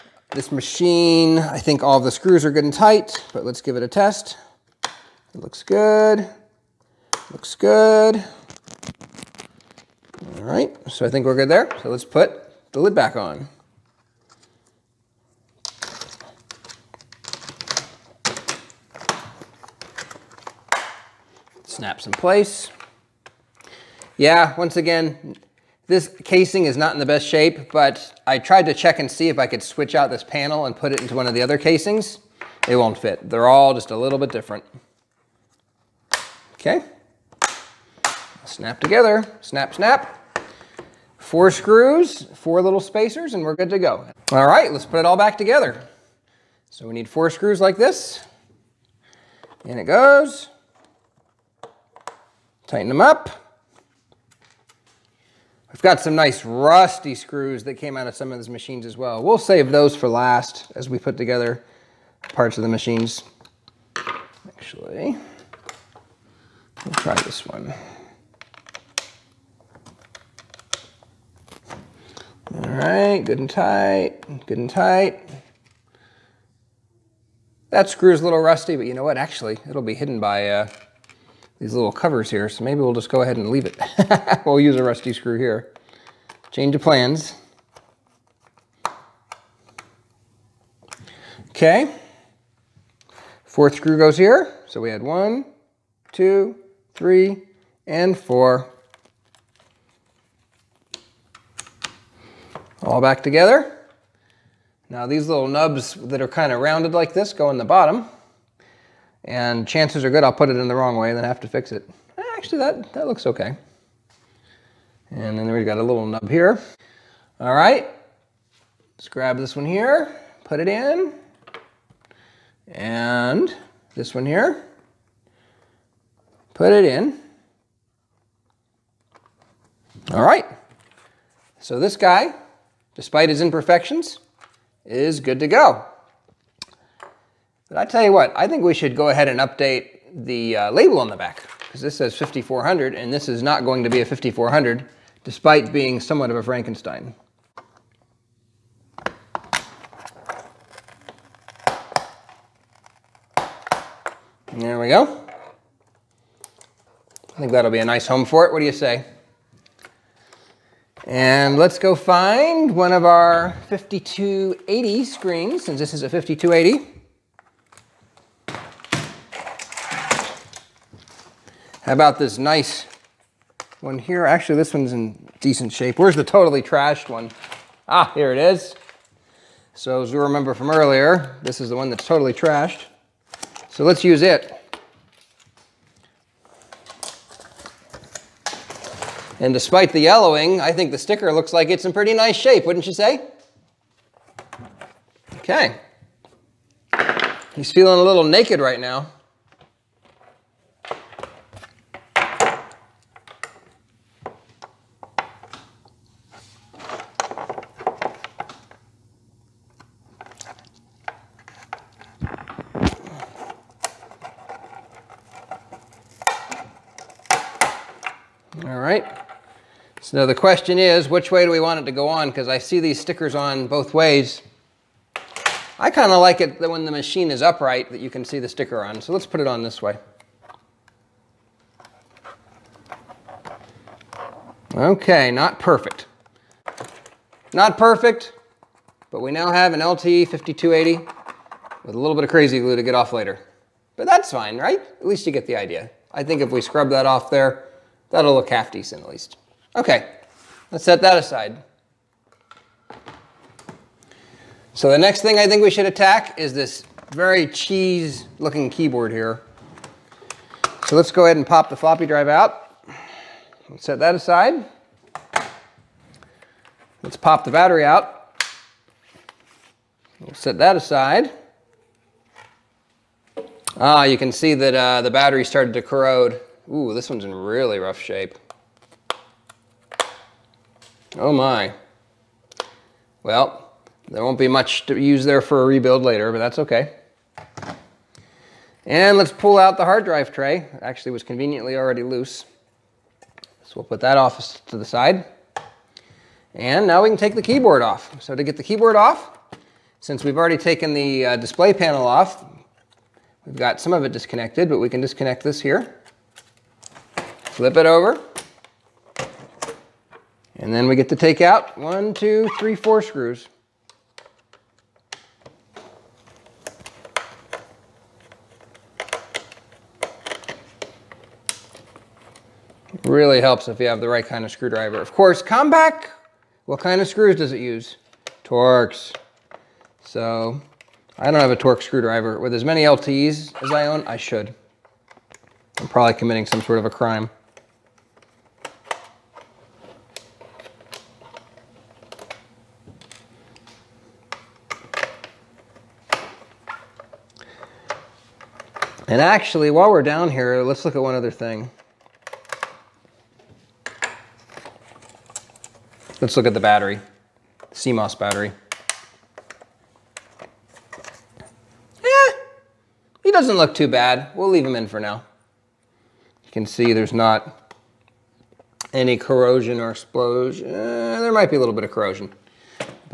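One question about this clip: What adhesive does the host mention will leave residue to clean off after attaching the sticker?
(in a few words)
crazy glue.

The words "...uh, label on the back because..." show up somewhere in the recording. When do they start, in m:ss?
2:20.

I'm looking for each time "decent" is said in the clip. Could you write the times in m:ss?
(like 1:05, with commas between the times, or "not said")
2:55, 4:08.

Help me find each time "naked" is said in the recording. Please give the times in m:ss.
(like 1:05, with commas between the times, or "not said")
3:18.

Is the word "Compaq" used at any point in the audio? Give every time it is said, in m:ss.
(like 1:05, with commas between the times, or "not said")
5:25.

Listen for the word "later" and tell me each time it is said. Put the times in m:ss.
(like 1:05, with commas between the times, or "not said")
4:03, 4:46.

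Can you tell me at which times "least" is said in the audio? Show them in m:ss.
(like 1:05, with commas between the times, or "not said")
4:05, 4:09.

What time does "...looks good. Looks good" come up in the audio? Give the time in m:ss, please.
0:05.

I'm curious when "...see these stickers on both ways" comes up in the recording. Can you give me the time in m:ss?
3:42.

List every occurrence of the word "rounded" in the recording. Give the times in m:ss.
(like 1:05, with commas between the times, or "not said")
1:46.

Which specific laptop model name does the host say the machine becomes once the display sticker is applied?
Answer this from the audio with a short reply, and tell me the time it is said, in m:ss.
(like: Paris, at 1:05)
LTE 5280, at 3:59.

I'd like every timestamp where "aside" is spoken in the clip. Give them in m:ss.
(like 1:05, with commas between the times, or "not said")
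4:11, 4:24, 4:30.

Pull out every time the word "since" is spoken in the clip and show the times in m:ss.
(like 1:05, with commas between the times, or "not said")
2:45, 4:59.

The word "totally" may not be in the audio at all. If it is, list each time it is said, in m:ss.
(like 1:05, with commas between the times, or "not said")
2:56, 3:02.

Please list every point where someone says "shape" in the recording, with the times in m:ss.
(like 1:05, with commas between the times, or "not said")
0:27, 2:55, 3:12, 4:38.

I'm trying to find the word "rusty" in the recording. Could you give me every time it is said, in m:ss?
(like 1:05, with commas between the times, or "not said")
0:56, 1:18, 1:24.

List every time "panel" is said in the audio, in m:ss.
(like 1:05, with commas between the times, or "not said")
0:30, 5:01.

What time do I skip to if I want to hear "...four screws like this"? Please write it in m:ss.
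0:47.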